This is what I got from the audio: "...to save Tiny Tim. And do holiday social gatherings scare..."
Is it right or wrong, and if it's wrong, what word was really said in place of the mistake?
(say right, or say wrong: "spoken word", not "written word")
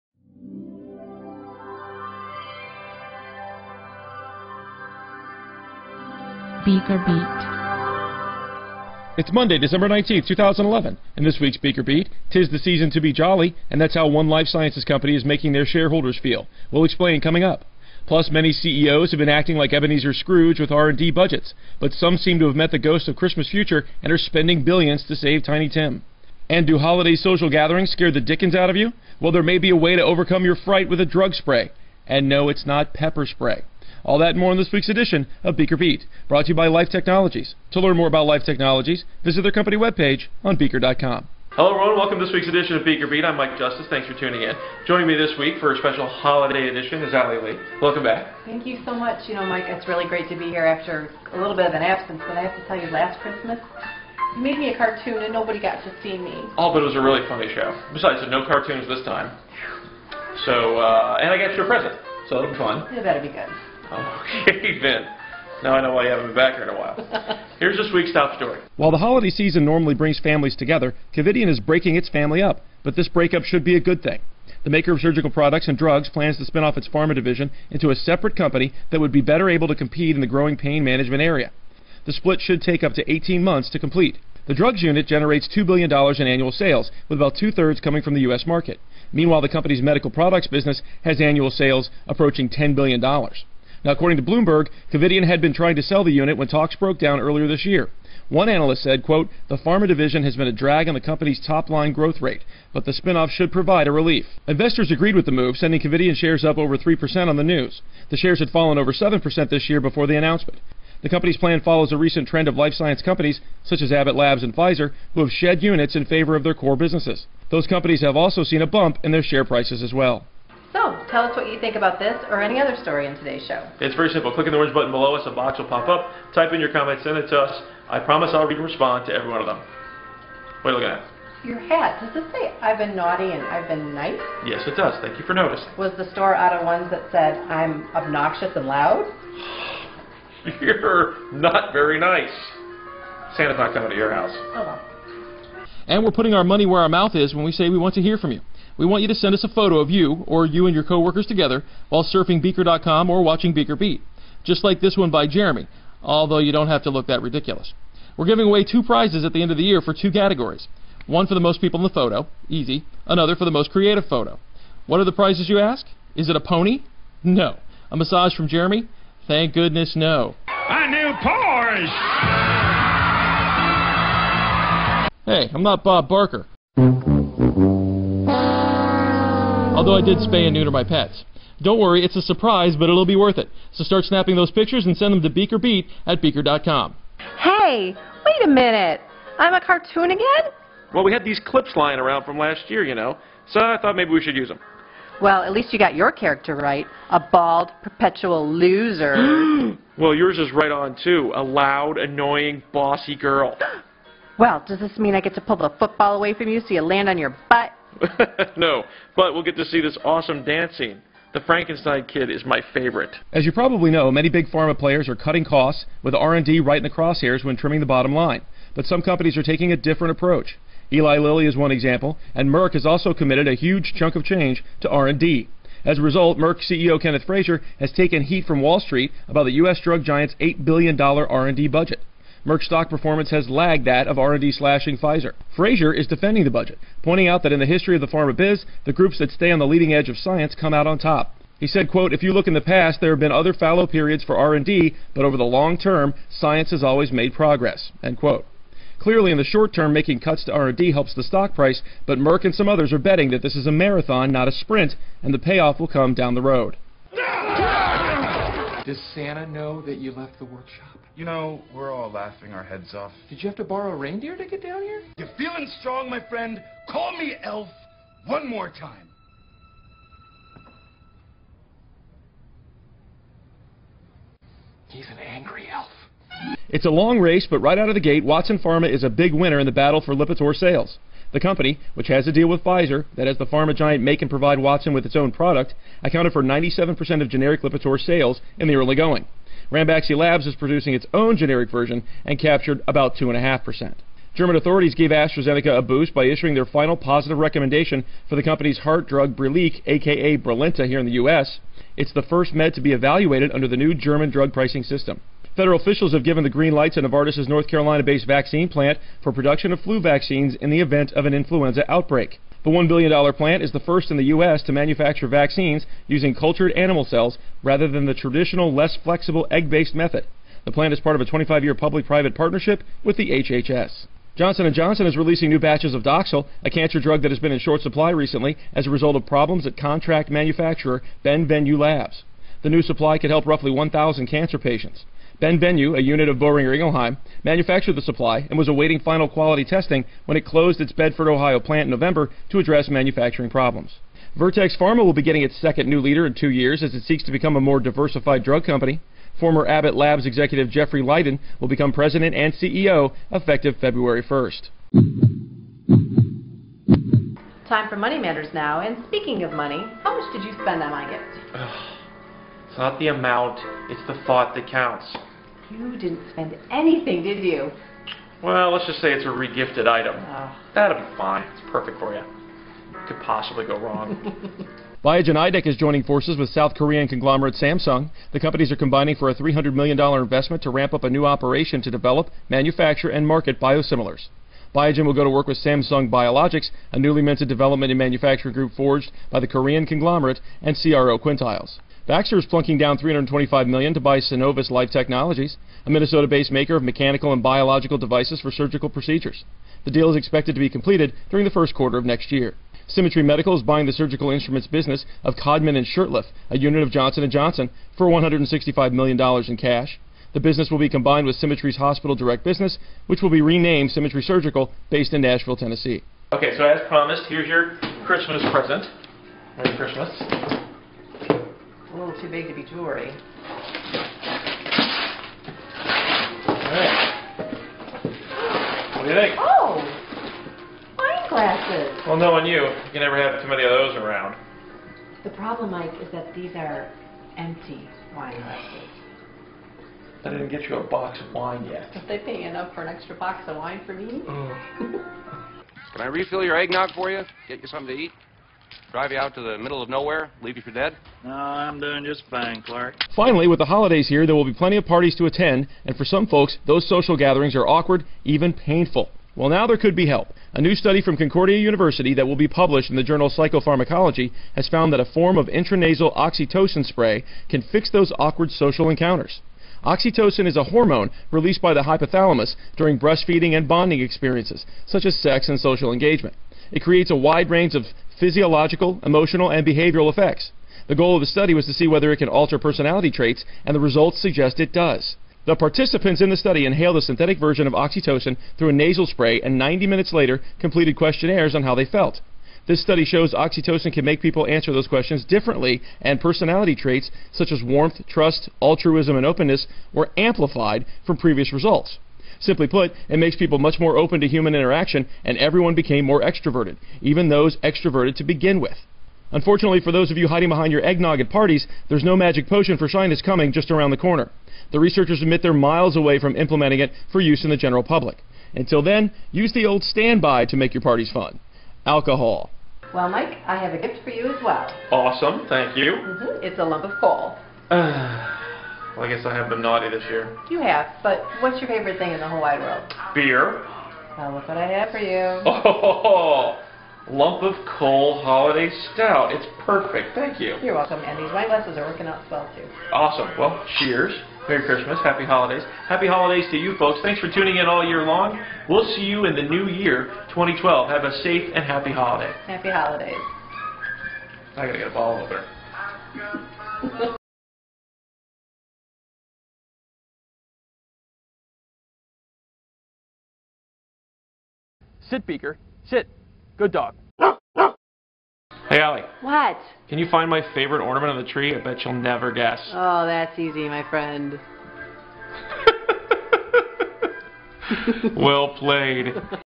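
right.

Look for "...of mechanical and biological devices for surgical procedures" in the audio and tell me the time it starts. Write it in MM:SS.
06:36.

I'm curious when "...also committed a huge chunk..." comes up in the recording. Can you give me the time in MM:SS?
03:42.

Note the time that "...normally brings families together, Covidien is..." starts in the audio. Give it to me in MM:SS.
01:09.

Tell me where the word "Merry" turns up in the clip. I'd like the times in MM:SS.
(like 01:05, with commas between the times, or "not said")
06:59, 09:04.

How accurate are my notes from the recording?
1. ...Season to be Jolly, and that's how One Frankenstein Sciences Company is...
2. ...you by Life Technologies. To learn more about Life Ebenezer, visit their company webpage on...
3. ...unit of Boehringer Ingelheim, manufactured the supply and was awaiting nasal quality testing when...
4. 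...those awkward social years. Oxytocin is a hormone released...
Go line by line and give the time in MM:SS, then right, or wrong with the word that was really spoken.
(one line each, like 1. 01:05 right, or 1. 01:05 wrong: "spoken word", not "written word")
1. 00:12 wrong: "Life", not "Frankenstein"
2. 00:36 wrong: "Technologies", not "Ebenezer"
3. 05:35 wrong: "final", not "nasal"
4. 07:47 wrong: "encounters", not "years".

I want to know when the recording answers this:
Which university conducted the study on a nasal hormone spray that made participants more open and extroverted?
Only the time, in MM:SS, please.
07:41.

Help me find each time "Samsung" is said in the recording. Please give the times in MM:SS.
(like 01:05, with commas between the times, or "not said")
06:17, 06:25.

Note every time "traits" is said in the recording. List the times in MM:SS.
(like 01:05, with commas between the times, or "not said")
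08:03, 08:16.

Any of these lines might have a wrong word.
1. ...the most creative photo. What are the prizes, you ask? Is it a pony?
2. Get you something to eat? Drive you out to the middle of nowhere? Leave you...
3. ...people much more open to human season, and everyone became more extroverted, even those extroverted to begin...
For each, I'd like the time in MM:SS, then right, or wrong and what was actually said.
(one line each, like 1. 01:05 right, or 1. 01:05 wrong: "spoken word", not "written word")
1. 02:43 right
2. 07:27 right
3. 08:23 wrong: "interaction", not "season".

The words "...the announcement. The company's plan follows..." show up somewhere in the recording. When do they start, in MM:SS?
01:50.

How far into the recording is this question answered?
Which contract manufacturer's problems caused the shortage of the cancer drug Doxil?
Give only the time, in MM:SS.
05:31.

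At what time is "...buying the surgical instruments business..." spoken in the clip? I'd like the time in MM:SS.
06:43.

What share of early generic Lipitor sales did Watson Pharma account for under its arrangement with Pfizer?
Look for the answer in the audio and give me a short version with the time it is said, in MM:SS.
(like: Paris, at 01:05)
97%, at 04:46.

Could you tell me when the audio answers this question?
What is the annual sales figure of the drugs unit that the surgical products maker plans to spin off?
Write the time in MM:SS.
01:25.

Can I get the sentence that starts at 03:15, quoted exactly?
Well, at least you got your character right.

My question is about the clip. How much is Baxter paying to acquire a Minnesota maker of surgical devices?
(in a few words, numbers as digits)
$325 million.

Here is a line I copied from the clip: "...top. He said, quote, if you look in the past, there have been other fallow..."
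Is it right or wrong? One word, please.
right.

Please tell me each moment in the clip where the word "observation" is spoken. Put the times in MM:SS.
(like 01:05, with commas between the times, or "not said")
not said.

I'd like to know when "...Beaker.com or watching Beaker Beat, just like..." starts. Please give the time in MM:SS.
02:32.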